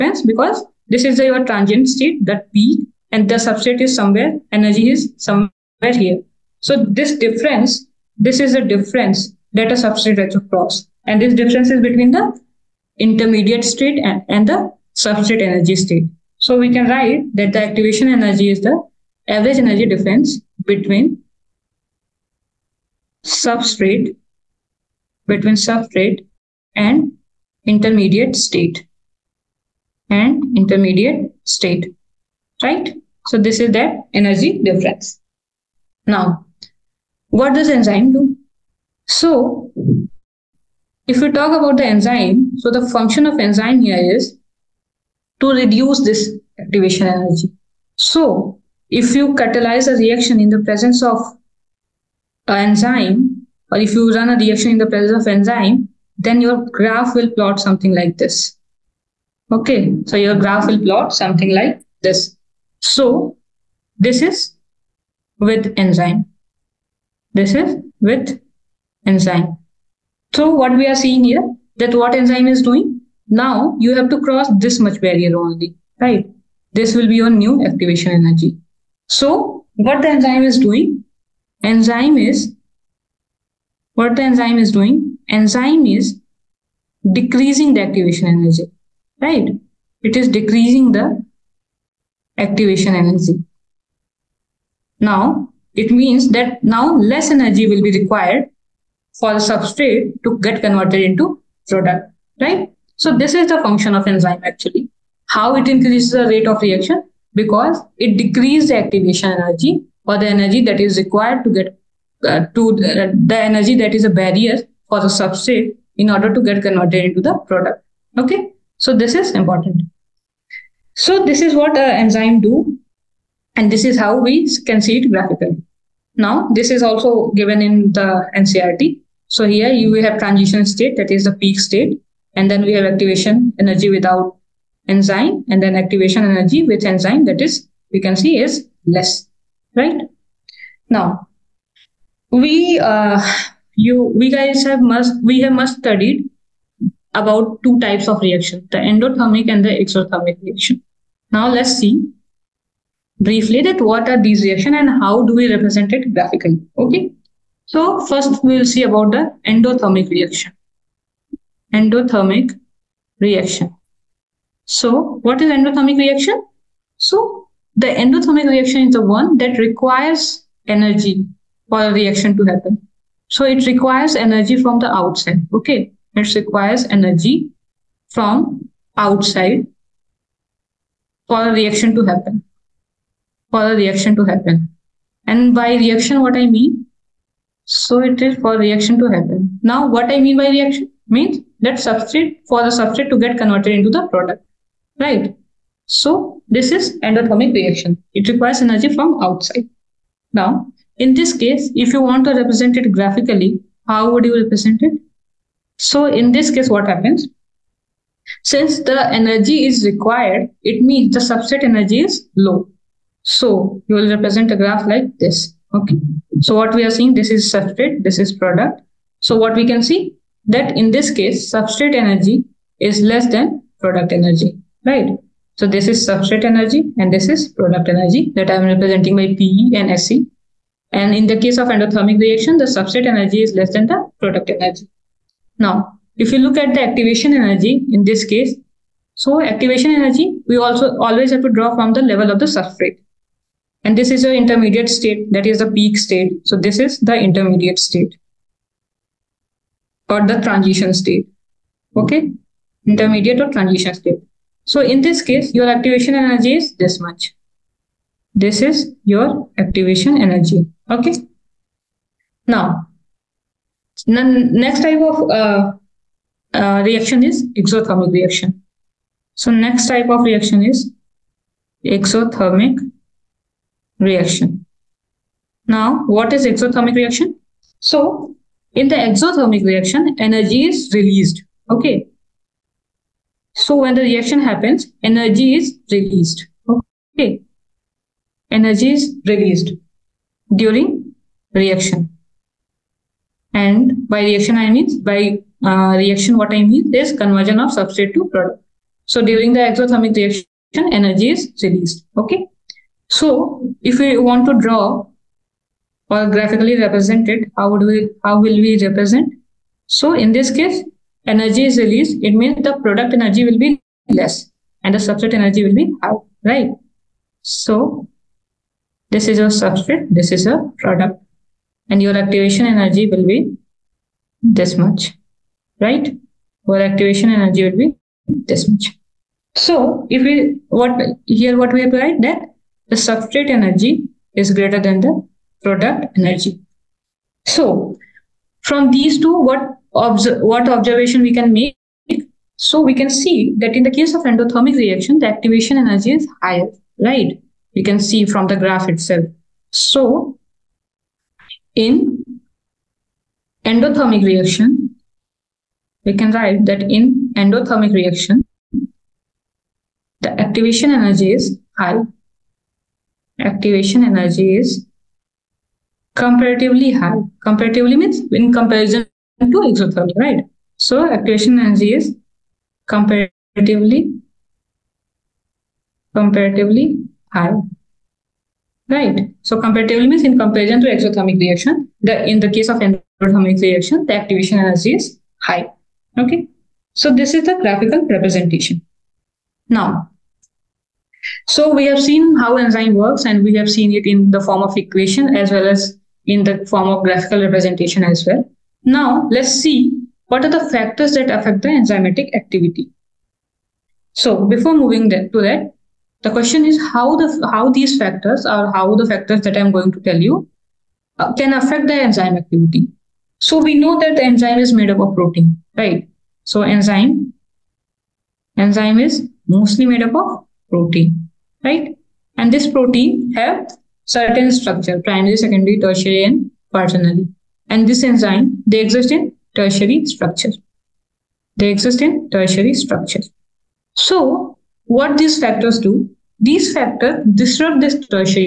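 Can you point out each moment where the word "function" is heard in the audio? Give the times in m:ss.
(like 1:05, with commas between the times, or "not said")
0:42, 1:43.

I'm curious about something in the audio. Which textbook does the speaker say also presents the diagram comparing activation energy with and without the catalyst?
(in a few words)
NCERT.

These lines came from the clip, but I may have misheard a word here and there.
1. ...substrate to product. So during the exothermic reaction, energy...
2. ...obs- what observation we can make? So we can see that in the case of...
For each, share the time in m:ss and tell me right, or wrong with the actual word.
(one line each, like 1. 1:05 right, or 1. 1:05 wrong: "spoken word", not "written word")
1. 4:57 right
2. 5:39 right.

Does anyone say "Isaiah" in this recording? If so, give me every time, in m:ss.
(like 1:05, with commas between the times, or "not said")
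not said.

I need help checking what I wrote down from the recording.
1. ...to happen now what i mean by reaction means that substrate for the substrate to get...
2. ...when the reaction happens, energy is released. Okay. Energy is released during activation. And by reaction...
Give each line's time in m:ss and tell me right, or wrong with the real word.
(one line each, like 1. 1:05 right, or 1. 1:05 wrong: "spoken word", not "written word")
1. 3:09 right
2. 4:43 wrong: "reaction", not "activation".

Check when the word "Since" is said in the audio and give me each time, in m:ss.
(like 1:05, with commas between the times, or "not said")
3:28.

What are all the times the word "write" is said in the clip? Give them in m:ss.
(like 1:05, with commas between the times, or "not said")
0:16, 5:31, 5:56.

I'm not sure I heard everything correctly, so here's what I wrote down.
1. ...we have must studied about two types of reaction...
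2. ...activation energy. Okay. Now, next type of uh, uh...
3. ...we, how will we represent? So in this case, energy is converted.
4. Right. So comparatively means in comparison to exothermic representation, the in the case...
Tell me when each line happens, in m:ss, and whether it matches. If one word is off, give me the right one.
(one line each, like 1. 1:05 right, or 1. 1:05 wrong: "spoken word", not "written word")
1. 2:25 right
2. 4:19 right
3. 5:07 wrong: "released", not "converted"
4. 6:18 wrong: "reaction", not "representation".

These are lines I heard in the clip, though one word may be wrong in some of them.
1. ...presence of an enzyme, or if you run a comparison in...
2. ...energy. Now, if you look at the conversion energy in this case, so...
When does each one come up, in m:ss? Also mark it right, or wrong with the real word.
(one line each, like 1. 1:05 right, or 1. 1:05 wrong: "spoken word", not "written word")
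1. 0:50 wrong: "reaction", not "comparison"
2. 3:54 wrong: "activation", not "conversion".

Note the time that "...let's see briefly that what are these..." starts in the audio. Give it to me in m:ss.
2:31.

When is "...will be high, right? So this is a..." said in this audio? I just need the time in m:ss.
5:15.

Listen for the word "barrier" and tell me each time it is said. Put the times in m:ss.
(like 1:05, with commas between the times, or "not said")
1:15, 1:54.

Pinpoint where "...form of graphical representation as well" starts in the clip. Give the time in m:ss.
6:36.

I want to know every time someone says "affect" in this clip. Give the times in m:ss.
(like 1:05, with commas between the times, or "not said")
6:41, 6:51.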